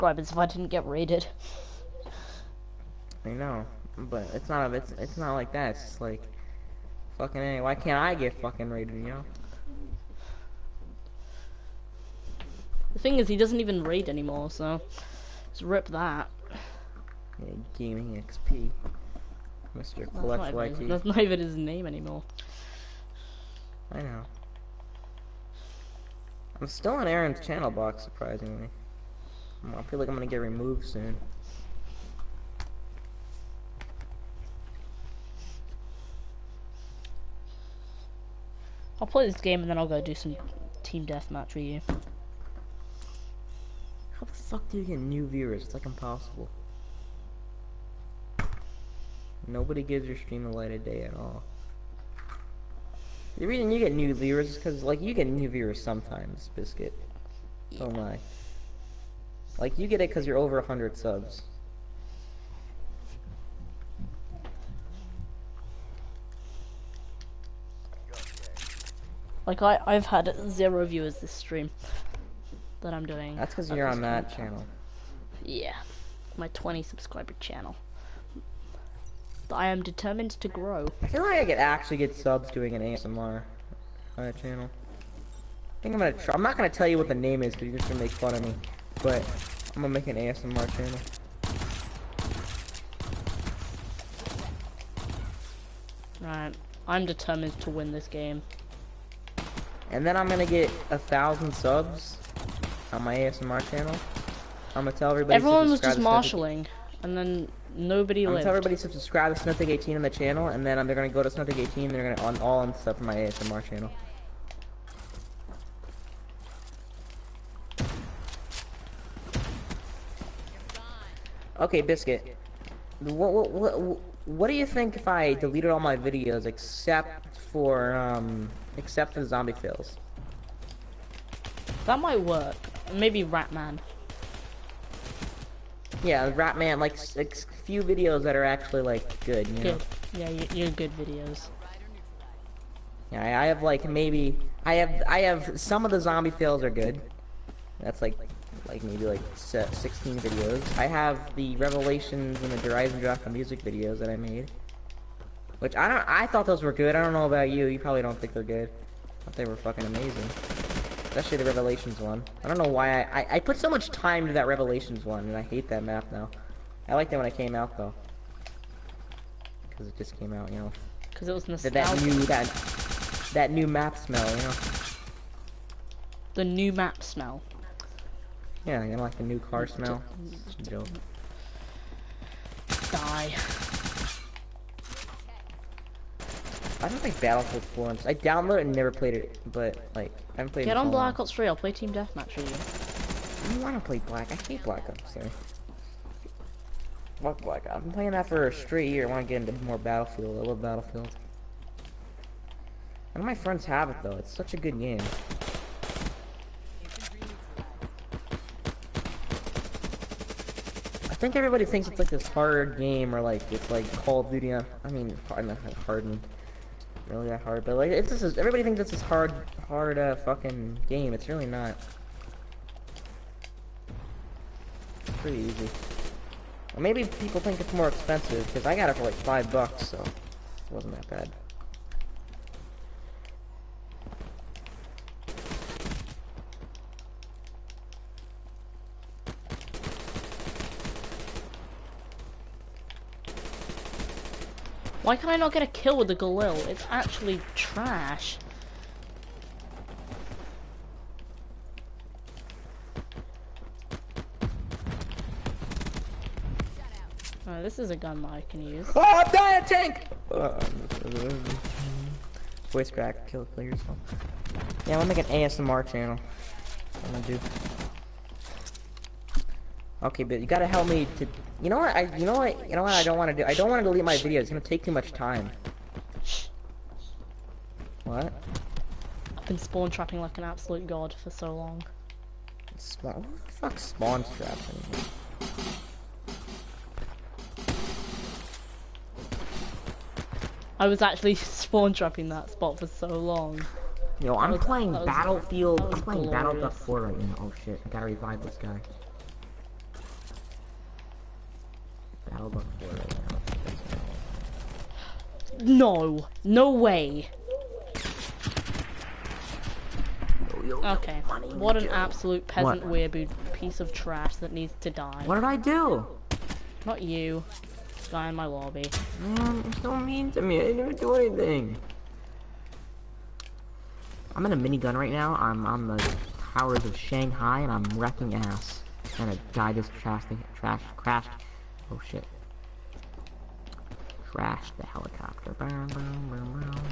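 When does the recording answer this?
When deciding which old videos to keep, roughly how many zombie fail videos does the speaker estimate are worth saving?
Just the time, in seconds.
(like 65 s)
149 s.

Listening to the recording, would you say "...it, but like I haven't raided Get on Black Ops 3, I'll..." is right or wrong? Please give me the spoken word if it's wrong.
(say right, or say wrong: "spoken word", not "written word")
wrong: "played", not "raided".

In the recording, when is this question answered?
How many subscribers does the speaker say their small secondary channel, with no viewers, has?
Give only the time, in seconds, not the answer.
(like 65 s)
76 s.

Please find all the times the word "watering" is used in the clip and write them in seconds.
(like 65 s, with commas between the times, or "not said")
not said.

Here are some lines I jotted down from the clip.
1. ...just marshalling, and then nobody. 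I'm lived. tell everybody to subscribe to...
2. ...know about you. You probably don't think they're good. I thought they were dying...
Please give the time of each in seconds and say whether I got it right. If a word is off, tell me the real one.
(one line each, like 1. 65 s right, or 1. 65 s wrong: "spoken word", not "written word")
1. 105 s right
2. 157 s wrong: "fucking", not "dying".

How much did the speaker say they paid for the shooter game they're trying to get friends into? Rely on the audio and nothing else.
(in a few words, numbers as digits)
five bucks.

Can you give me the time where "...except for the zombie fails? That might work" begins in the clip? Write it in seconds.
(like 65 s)
128 s.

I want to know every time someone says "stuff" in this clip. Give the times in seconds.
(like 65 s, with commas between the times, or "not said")
112 s.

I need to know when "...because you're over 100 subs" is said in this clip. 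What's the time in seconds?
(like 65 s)
60 s.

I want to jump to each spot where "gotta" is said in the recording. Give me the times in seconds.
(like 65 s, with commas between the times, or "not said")
270 s, 297 s.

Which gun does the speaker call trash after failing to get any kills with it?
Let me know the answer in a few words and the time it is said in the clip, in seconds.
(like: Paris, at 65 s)
Galil, at 246 s.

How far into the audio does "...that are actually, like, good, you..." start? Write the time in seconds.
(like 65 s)
138 s.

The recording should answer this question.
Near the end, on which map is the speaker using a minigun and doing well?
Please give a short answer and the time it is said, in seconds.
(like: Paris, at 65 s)
Shanghai, at 326 s.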